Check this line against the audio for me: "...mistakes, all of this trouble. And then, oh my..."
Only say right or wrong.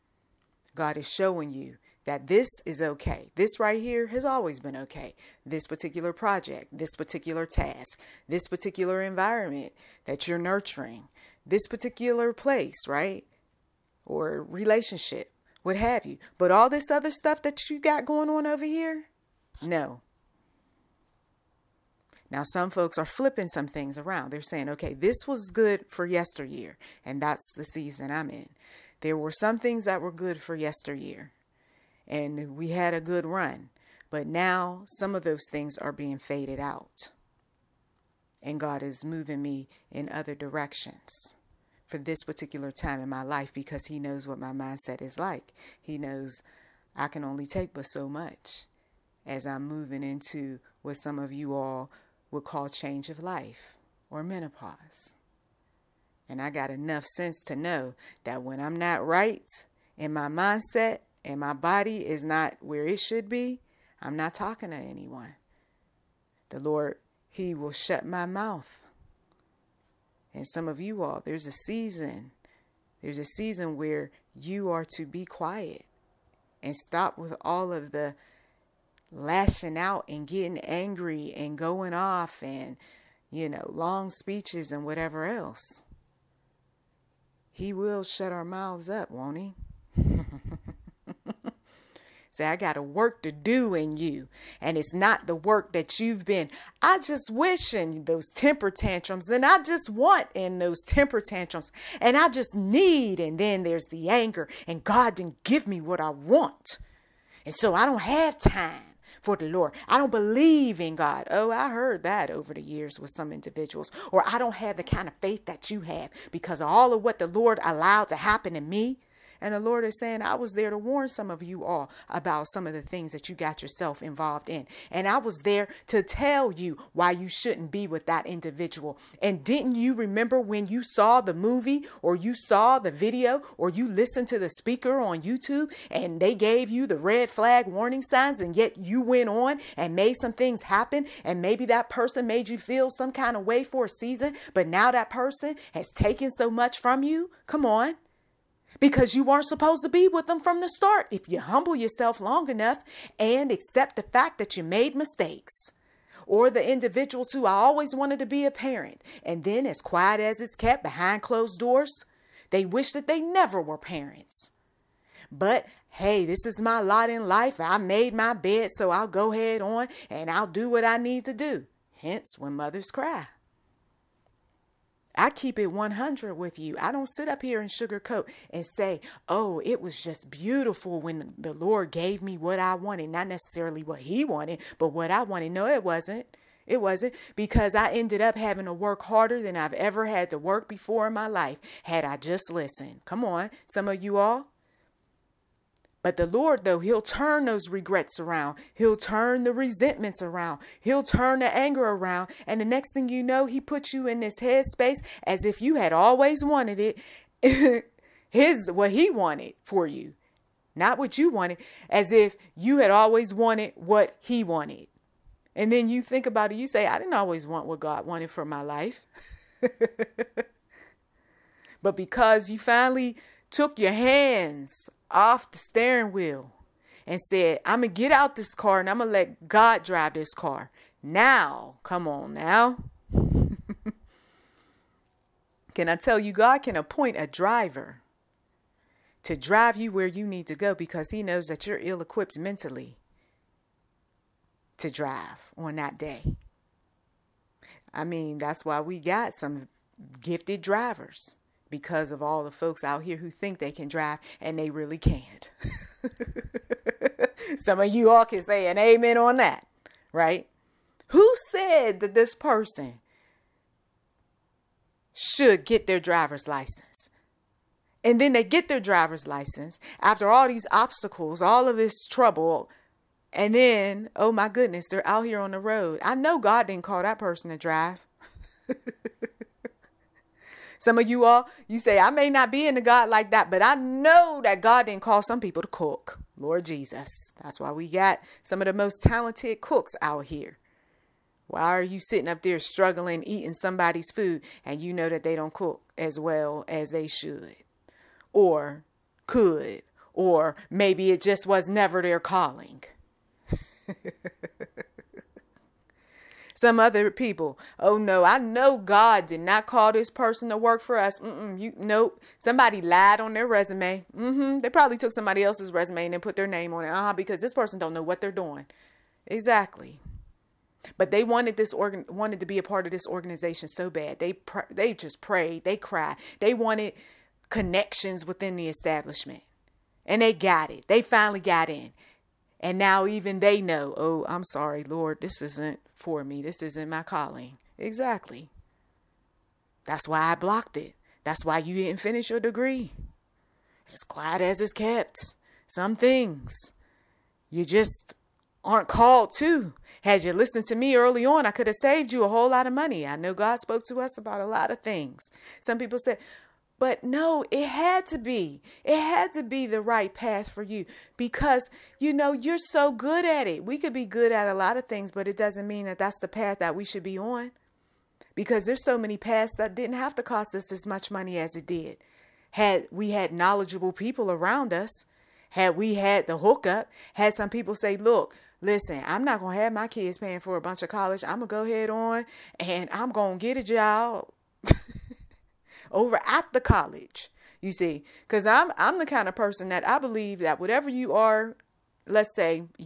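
wrong.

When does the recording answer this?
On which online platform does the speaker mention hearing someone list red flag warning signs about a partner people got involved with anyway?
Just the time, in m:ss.
2:15.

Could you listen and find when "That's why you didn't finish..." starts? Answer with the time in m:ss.
5:41.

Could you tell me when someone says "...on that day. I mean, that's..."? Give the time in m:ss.
4:05.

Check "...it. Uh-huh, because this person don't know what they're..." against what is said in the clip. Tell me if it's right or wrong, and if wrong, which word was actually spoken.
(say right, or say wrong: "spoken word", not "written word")
right.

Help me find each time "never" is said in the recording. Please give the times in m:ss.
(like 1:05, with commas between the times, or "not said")
2:43, 5:01.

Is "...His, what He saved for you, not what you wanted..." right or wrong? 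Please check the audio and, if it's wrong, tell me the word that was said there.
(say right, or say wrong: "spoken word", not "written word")
wrong: "wanted", not "saved".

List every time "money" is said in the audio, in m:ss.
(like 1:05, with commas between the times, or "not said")
5:52, 6:11.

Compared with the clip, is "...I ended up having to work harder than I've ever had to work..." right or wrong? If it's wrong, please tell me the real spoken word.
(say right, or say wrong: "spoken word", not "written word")
right.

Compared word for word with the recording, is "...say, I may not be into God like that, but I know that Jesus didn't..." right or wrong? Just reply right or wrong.
wrong.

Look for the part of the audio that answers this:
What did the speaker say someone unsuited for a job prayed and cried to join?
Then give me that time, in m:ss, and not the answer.
5:23.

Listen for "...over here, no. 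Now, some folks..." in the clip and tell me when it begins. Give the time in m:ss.
0:18.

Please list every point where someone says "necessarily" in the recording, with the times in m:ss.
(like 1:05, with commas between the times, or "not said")
3:03.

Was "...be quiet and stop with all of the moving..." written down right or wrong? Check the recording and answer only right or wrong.
wrong.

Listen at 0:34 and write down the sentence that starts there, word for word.
But now some of those things are being faded out.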